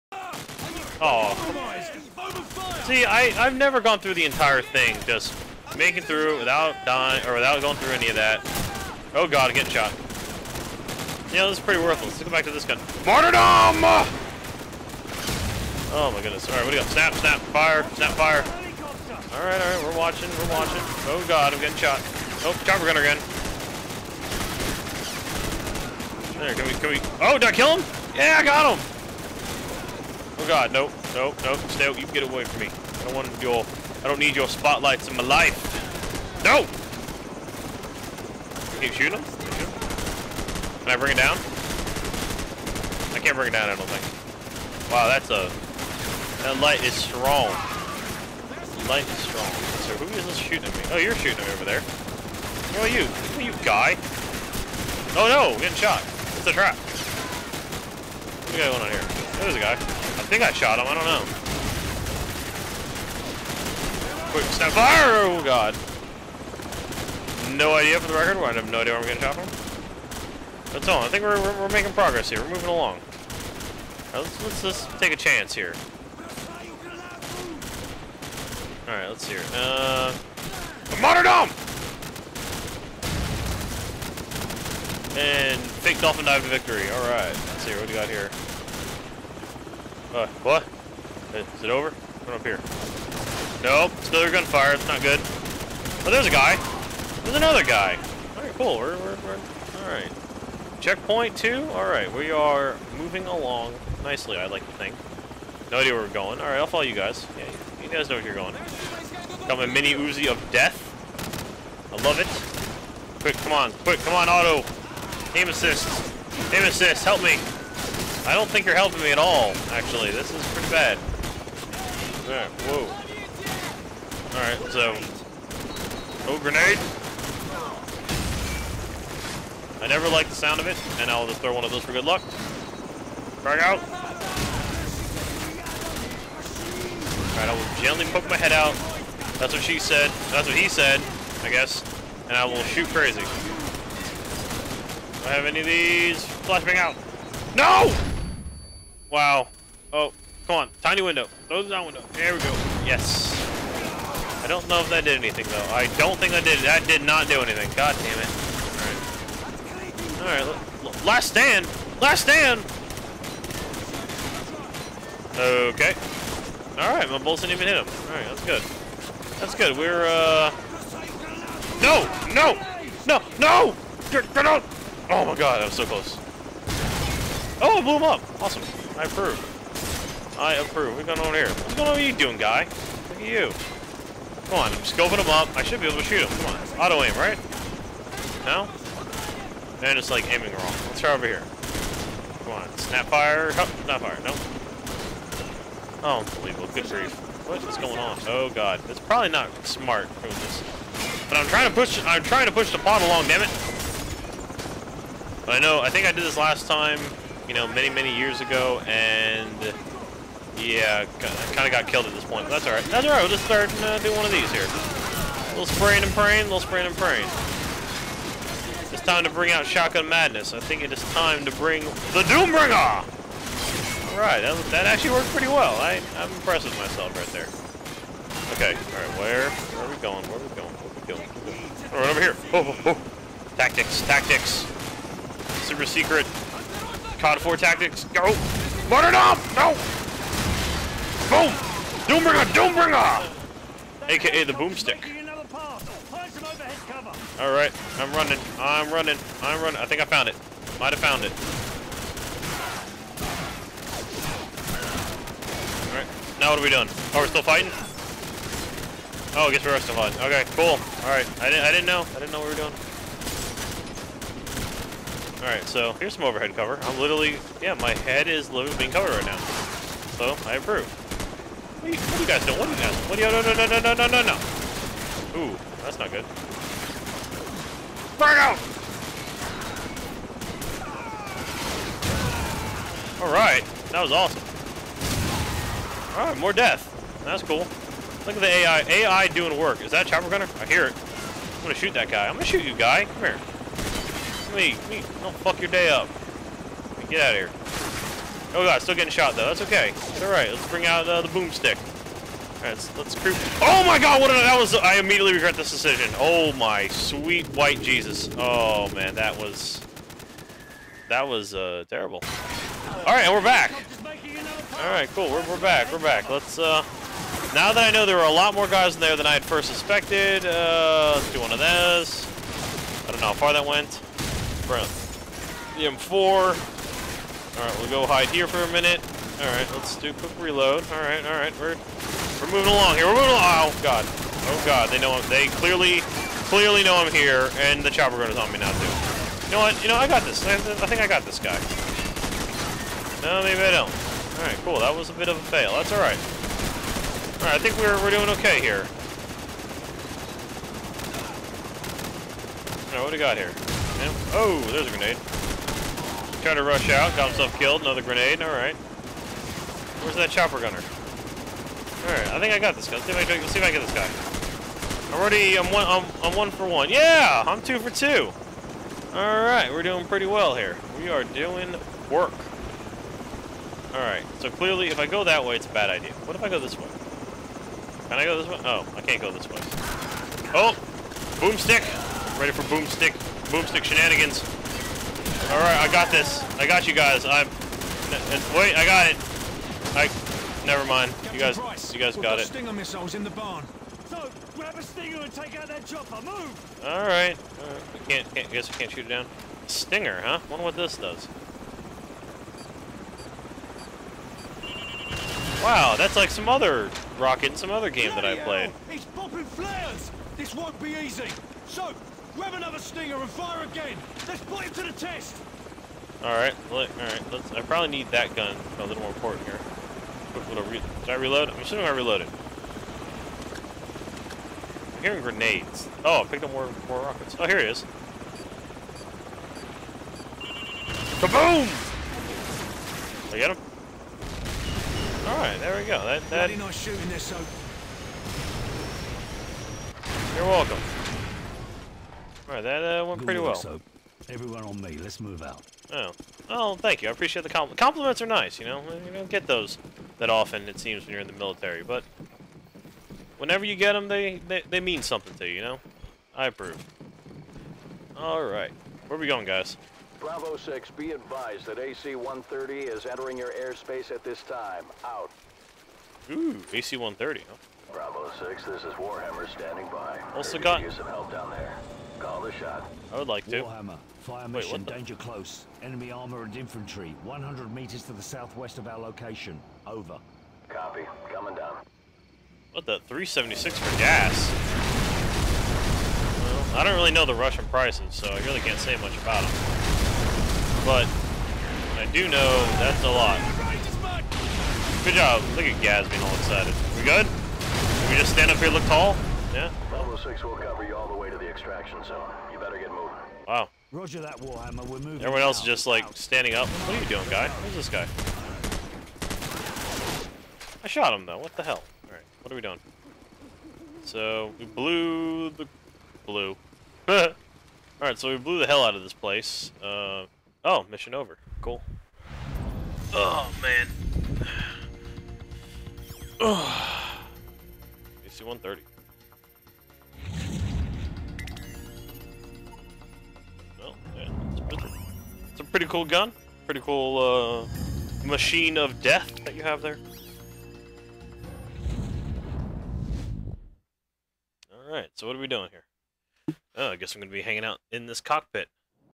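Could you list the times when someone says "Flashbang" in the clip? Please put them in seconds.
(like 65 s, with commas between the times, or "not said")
146 s.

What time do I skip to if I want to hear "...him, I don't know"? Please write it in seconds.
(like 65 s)
60 s.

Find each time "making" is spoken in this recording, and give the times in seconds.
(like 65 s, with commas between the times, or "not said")
5 s, 71 s.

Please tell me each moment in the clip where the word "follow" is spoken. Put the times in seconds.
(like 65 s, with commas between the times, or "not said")
106 s.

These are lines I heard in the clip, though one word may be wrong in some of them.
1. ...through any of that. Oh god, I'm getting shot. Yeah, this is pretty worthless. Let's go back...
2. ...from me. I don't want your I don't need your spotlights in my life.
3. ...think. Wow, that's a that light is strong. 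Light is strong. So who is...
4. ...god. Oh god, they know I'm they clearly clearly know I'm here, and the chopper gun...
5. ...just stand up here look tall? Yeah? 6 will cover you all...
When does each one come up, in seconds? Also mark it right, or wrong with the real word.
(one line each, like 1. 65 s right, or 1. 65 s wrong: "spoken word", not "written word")
1. 7 s right
2. 32 s right
3. 43 s right
4. 333 s right
5. 498 s right.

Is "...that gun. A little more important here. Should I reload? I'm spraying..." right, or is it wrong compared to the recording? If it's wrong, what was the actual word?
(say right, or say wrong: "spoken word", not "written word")
wrong: "assuming", not "spraying".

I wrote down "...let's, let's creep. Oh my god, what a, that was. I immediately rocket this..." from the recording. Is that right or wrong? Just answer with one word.
wrong.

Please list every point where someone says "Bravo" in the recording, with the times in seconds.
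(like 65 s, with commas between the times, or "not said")
460 s, 467 s.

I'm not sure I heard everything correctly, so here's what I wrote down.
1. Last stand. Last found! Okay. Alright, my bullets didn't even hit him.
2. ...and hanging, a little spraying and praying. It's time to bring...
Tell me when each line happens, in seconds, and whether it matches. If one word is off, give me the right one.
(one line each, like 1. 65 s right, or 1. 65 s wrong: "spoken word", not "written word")
1. 161 s wrong: "stand", not "found"
2. 216 s wrong: "praying", not "hanging".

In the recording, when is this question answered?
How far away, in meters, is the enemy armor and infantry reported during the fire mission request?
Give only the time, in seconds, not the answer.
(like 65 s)
477 s.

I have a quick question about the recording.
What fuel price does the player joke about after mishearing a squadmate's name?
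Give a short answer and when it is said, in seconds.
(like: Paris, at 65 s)
376, at 483 s.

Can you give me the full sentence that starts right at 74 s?
let's, let's, take a chance here.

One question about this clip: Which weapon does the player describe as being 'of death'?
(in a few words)
mini Uzi.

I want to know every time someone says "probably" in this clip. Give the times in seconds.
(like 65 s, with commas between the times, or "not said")
198 s, 417 s.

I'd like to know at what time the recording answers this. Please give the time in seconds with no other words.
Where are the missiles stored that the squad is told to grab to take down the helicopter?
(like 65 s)
393 s.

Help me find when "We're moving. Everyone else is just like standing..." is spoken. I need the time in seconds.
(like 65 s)
504 s.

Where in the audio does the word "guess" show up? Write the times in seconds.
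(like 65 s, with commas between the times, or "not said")
141 s, 259 s, 398 s, 546 s.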